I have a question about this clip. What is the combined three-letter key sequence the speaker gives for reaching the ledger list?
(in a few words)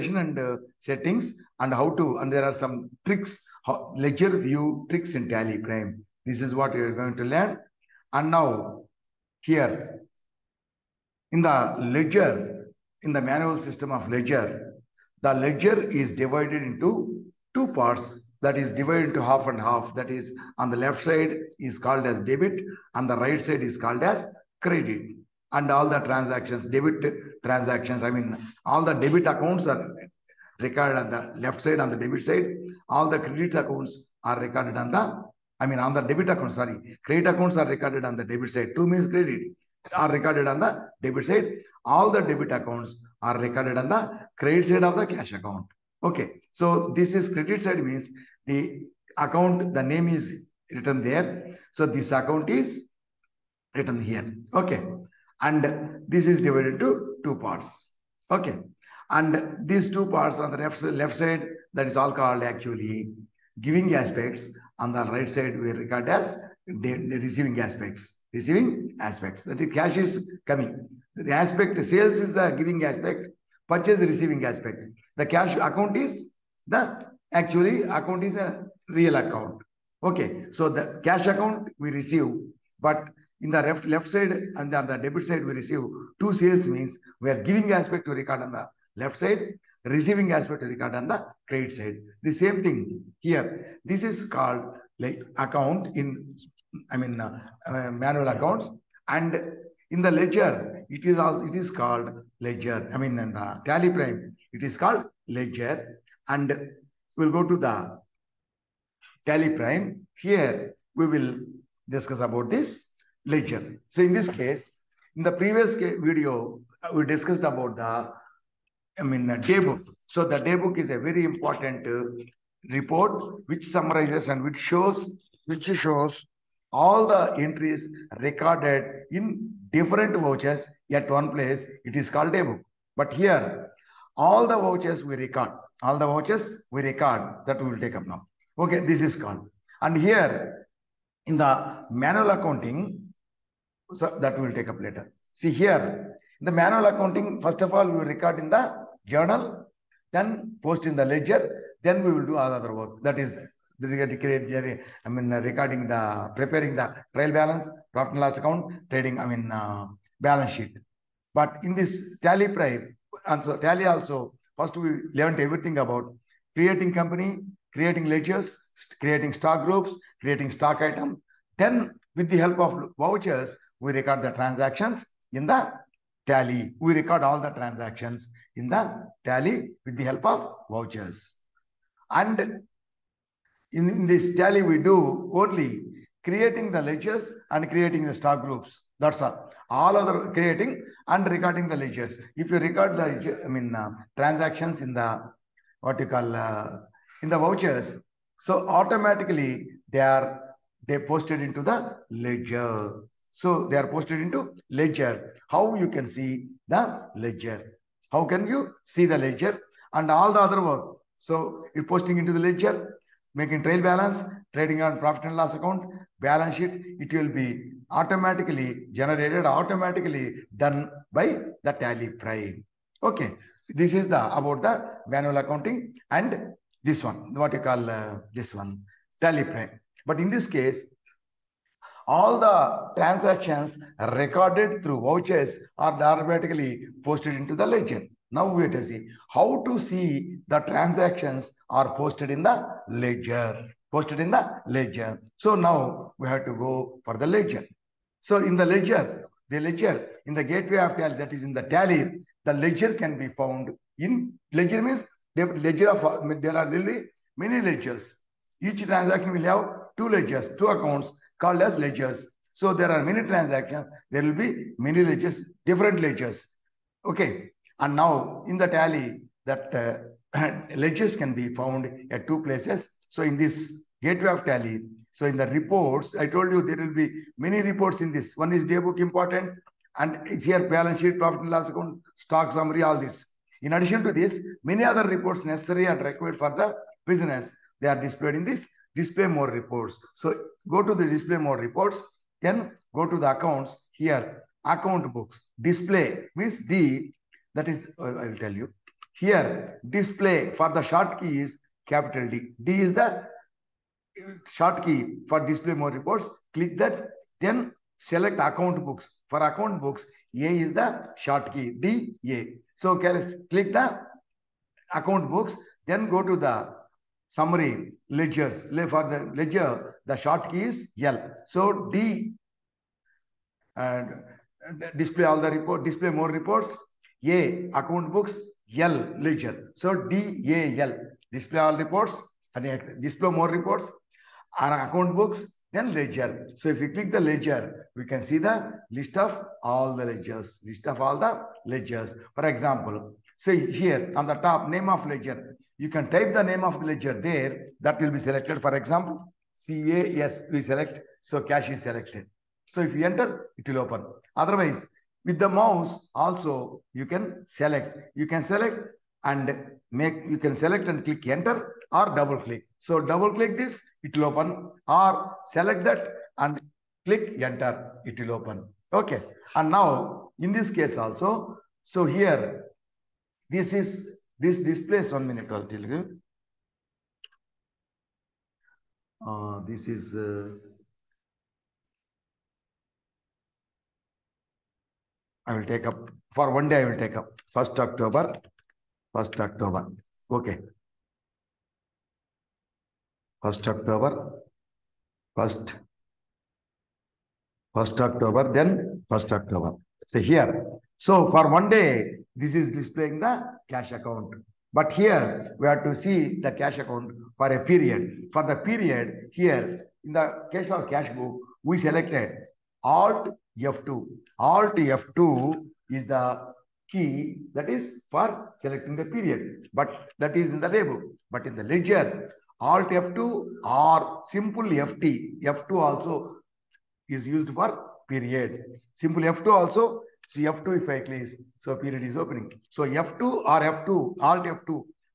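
DAL.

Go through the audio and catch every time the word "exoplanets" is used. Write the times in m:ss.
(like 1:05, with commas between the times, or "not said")
not said.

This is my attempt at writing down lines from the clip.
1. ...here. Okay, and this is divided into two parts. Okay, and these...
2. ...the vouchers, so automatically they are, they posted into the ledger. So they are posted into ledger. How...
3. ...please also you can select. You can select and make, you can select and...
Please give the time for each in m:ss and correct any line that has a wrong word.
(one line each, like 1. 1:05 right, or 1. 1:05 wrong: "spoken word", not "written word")
1. 0:54 right
2. 3:17 right
3. 5:55 wrong: "mouse", not "please".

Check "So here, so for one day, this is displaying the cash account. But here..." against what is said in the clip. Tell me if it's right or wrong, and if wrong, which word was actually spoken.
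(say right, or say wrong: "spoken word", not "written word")
right.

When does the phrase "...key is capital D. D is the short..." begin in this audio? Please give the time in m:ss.
5:01.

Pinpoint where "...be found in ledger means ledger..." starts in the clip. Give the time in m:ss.
4:13.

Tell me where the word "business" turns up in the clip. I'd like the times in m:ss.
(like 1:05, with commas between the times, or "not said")
4:47.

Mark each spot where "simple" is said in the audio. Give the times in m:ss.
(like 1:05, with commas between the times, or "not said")
7:04, 7:08.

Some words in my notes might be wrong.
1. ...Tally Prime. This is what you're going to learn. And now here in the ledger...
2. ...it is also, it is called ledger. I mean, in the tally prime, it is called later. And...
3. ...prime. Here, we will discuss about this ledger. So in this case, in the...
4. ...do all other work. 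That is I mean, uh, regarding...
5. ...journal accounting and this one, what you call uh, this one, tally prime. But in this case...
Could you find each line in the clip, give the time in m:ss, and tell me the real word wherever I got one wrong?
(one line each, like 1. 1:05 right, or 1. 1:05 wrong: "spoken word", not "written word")
1. 0:05 right
2. 1:40 wrong: "ledger", not "later"
3. 1:49 right
4. 2:32 right
5. 3:45 wrong: "manual", not "journal".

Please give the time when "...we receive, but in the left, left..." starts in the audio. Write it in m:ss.
1:21.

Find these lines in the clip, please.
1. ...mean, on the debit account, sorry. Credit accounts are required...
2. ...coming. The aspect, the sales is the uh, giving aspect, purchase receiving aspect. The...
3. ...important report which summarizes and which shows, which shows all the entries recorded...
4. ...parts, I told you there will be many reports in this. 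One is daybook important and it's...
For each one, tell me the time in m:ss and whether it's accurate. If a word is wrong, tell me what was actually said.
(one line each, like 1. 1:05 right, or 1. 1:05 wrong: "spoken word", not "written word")
1. 0:35 wrong: "recorded", not "required"
2. 1:10 right
3. 2:01 right
4. 4:35 wrong: "reports", not "parts".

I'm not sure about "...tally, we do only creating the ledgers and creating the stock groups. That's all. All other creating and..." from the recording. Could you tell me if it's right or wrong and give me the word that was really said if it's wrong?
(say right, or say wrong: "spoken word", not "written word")
right.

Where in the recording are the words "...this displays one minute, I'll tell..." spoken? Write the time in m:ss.
6:14.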